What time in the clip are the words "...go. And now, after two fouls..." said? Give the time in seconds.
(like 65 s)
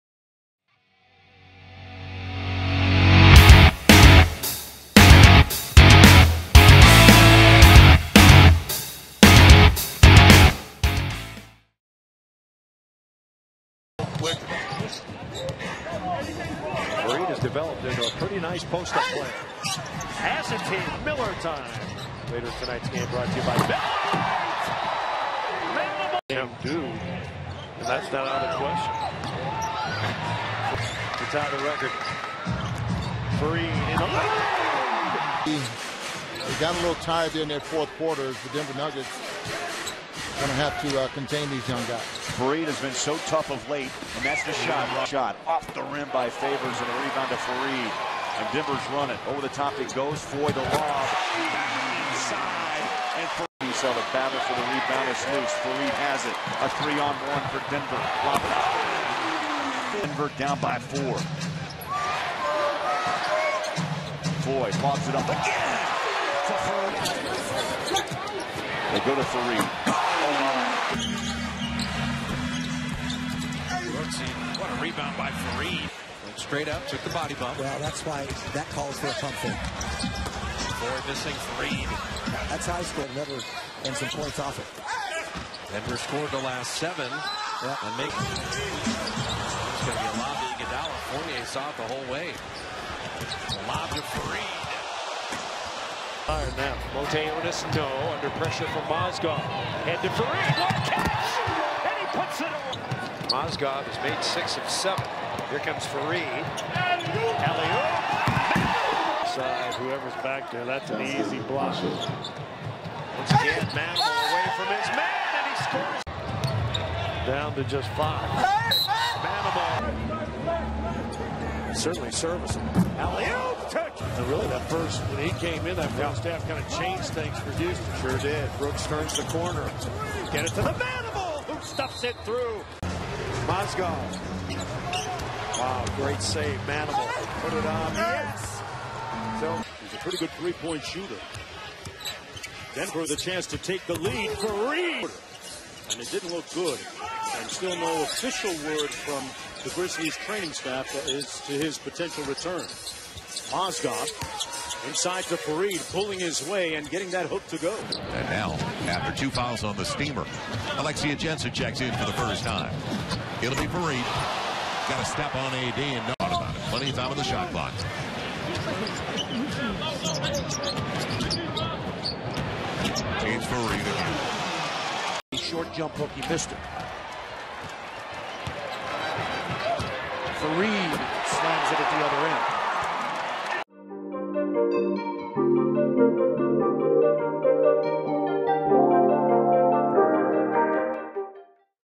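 157 s.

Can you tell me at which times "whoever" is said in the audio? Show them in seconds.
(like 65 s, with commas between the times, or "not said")
109 s.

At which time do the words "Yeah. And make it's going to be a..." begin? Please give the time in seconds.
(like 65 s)
87 s.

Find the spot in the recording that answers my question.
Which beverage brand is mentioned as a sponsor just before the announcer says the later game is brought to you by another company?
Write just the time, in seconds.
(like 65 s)
21 s.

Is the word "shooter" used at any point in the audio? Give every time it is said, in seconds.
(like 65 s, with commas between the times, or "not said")
140 s.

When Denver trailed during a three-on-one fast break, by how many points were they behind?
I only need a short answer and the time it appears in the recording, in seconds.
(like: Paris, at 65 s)
4, at 60 s.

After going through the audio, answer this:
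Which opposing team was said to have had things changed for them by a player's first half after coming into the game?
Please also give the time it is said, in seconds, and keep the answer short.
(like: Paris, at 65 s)
Houston, at 127 s.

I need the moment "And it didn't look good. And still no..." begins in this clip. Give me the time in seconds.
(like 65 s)
145 s.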